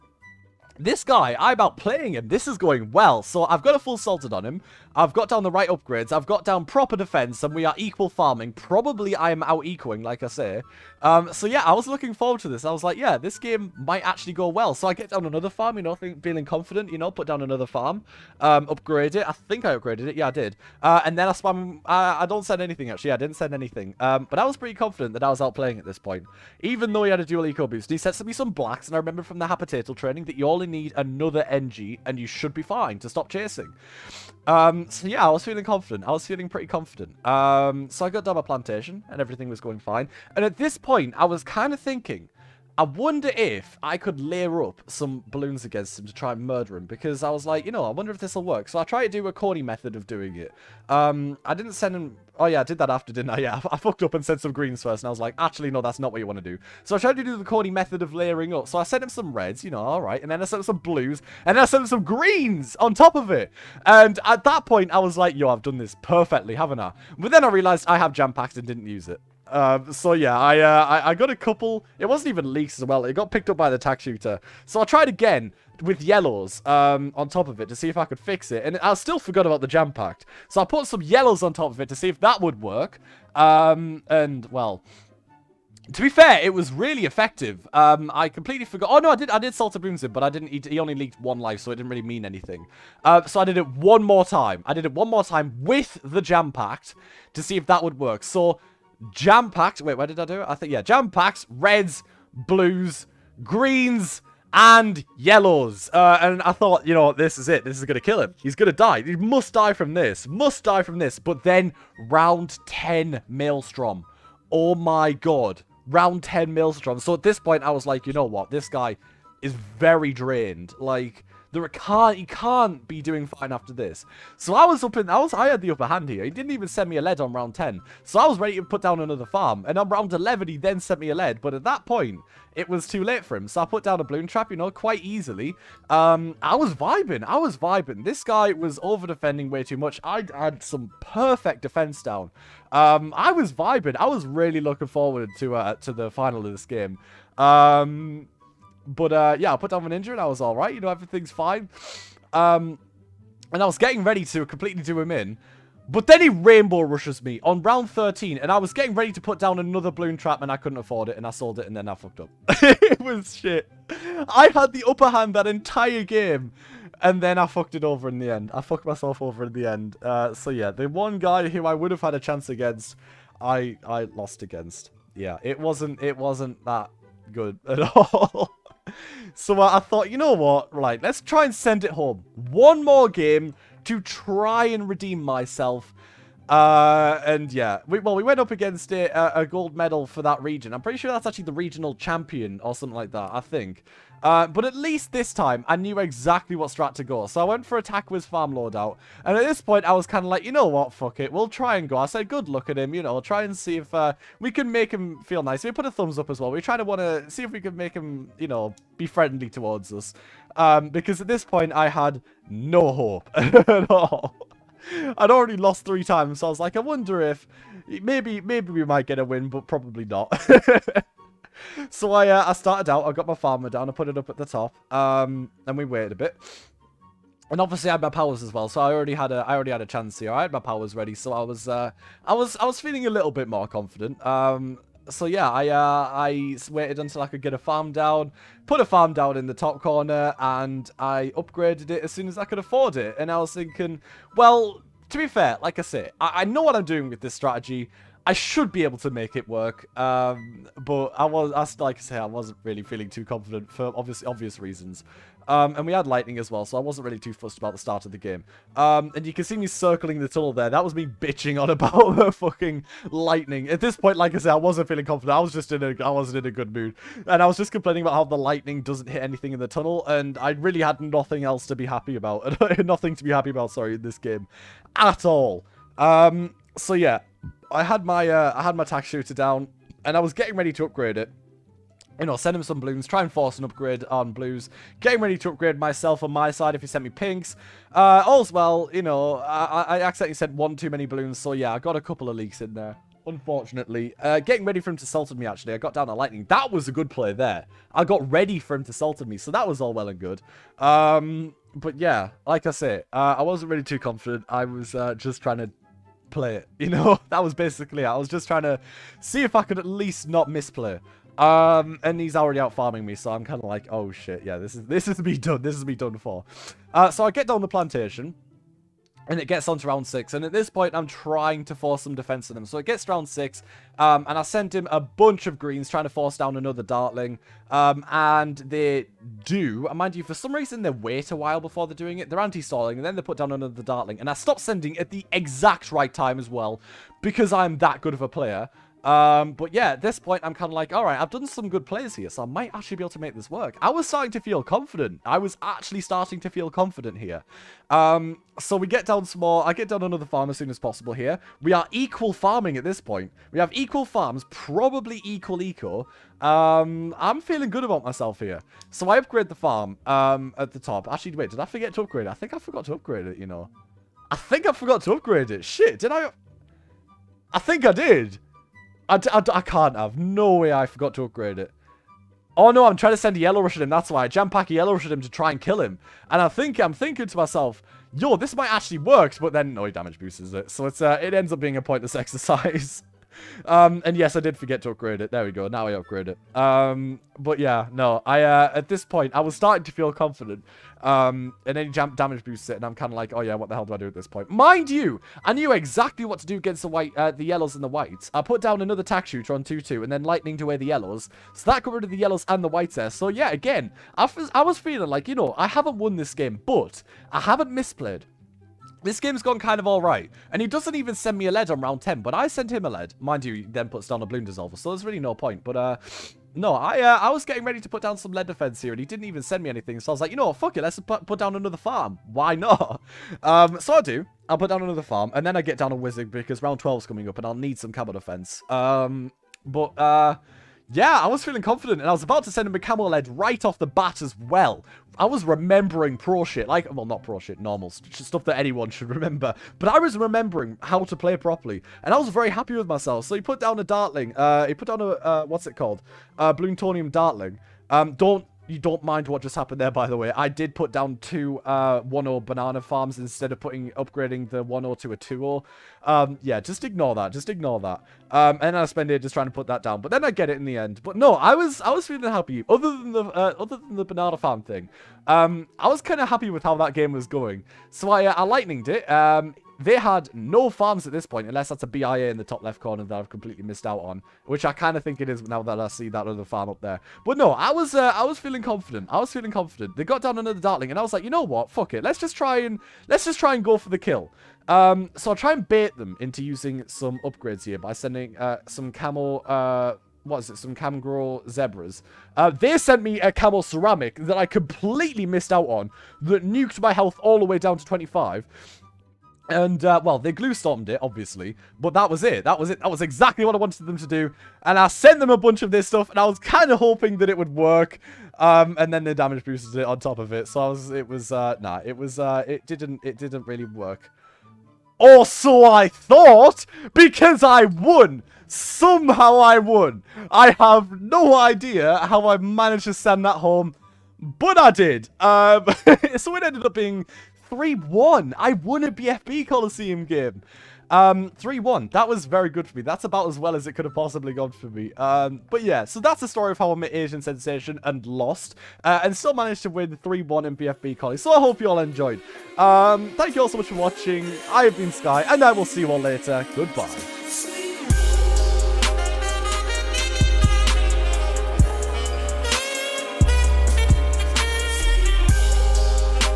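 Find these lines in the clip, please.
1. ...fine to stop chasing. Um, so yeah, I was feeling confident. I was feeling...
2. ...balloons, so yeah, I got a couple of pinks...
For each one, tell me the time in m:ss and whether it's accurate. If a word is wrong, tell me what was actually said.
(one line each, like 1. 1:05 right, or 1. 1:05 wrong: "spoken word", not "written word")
1. 0:32 right
2. 4:51 wrong: "leaks", not "pinks".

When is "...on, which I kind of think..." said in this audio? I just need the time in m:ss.
7:53.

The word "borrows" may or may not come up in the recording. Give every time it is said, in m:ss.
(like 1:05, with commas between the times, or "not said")
not said.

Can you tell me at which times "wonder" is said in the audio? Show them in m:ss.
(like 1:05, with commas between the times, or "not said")
0:42, 0:47, 3:36.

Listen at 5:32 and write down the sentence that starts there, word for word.
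They're anti-stalling, and then they put down another Dartling.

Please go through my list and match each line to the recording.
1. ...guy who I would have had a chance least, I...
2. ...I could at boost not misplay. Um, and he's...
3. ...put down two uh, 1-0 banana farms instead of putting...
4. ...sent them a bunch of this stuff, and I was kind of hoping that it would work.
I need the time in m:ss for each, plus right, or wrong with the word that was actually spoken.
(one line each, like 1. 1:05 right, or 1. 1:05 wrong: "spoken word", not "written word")
1. 2:51 wrong: "against", not "least"
2. 5:09 wrong: "least", not "boost"
3. 7:30 right
4. 8:24 right.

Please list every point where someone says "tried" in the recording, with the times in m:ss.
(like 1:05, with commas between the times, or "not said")
0:48, 0:56, 1:14.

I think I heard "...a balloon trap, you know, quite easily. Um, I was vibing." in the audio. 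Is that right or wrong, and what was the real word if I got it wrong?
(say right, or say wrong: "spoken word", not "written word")
right.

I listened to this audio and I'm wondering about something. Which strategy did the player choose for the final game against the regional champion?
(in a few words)
Attack with Farm Lord.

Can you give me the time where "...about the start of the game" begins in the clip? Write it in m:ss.
4:17.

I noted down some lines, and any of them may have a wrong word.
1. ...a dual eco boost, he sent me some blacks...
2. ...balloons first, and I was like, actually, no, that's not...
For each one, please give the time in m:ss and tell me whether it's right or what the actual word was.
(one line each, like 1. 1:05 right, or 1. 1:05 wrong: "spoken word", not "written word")
1. 0:27 right
2. 0:54 wrong: "greens", not "balloons".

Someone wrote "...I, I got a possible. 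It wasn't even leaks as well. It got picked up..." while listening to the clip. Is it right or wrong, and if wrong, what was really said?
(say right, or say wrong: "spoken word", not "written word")
wrong: "couple", not "possible".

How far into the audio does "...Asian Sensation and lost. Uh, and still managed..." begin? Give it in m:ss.
8:56.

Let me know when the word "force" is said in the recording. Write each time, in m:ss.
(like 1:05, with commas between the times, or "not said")
4:43, 5:21, 5:26.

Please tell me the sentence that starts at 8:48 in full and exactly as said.
I won a BFB Coliseum game.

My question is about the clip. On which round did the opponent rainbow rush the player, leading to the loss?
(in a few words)
13.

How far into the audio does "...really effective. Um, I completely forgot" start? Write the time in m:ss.
1:26.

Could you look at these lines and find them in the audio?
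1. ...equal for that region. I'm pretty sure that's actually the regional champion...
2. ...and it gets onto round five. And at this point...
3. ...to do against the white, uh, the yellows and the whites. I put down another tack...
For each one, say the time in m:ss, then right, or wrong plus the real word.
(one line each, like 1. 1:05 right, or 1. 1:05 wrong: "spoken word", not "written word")
1. 3:09 wrong: "medal", not "equal"
2. 5:19 wrong: "six", not "five"
3. 6:36 right.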